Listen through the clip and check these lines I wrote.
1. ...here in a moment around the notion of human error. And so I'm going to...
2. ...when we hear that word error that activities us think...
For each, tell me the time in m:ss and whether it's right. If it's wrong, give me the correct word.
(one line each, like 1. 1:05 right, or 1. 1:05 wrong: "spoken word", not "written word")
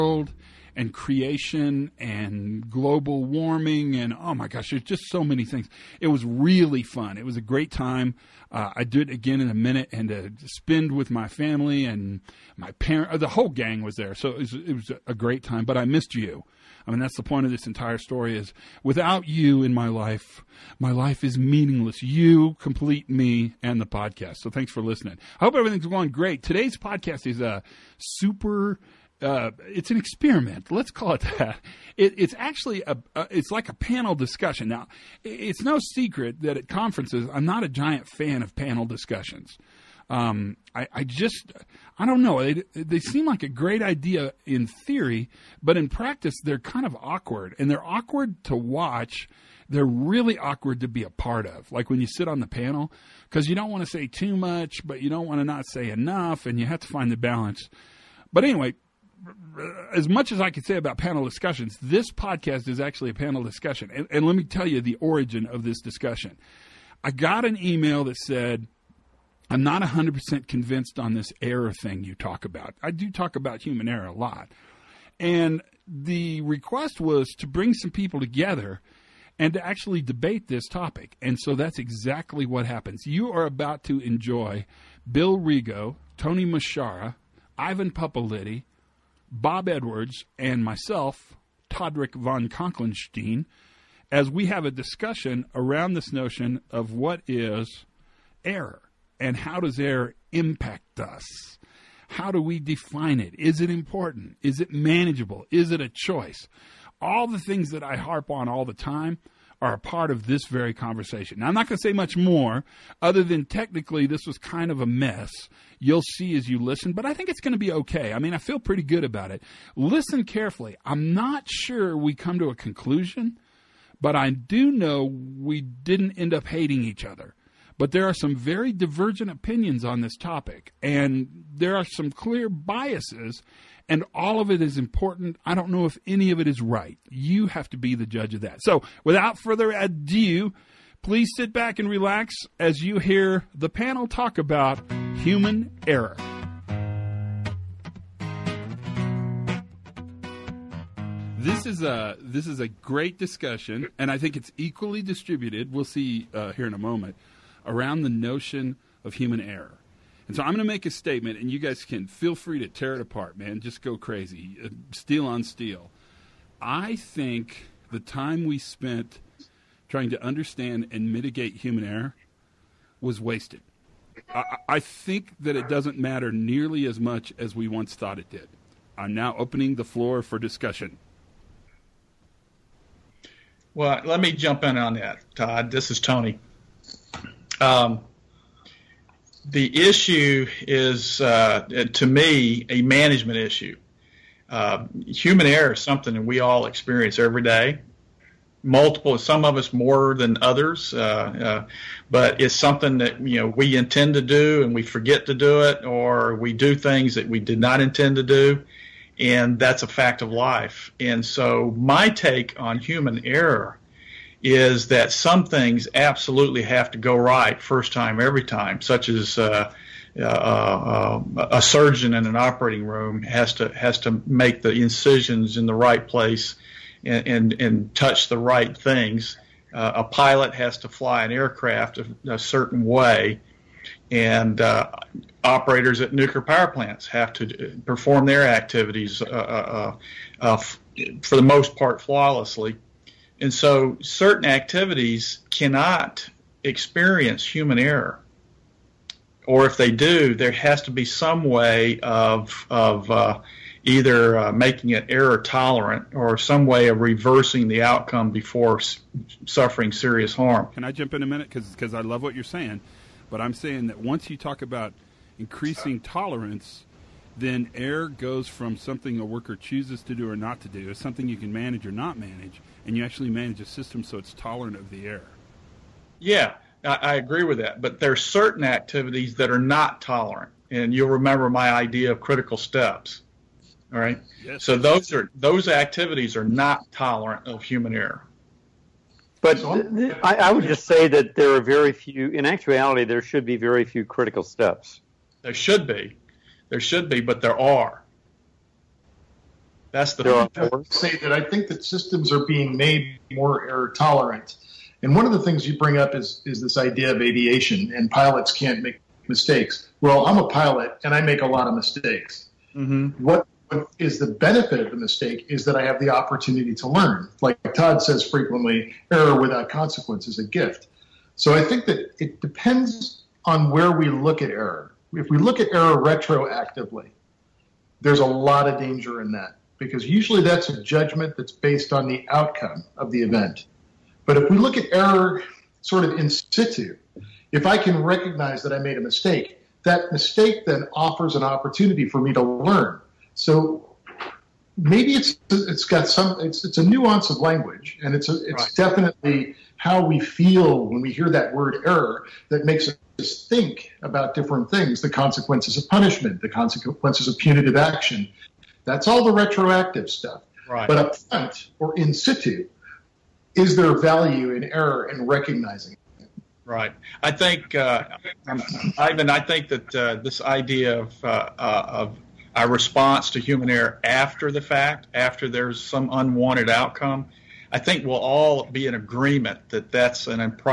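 1. 2:36 right
2. 5:50 wrong: "makes", not "activities".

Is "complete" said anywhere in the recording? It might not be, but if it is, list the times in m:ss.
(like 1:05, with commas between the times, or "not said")
0:22.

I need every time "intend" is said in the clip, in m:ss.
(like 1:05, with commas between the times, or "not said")
3:23, 3:27.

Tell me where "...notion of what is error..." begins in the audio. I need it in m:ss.
1:36.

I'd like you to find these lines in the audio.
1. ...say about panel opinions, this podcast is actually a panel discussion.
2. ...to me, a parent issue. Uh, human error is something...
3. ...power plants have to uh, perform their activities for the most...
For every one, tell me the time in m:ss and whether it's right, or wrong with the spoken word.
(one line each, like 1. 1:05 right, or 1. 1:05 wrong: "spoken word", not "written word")
1. 1:00 wrong: "discussions", not "opinions"
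2. 3:11 wrong: "management", not "parent"
3. 3:56 right.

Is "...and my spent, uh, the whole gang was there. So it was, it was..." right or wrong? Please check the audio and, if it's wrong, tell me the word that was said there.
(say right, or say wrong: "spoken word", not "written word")
wrong: "parent", not "spent".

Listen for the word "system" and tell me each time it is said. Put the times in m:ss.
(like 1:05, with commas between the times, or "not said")
4:33, 5:01.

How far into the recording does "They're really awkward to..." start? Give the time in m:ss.
0:49.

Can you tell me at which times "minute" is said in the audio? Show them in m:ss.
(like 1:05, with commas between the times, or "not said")
0:09, 4:21.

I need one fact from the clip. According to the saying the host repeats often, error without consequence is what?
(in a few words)
A gift.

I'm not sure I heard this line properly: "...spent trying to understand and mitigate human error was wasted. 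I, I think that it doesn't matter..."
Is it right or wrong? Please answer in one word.
right.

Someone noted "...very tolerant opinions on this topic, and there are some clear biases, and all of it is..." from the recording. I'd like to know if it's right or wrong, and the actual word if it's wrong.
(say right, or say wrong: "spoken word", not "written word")
wrong: "divergent", not "tolerant".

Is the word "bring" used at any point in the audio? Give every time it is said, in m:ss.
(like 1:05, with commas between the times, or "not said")
1:17, 5:05.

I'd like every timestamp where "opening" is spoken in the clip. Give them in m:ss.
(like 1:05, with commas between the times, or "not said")
2:59.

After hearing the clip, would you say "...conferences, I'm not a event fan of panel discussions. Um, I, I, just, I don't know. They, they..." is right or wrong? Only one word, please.
wrong.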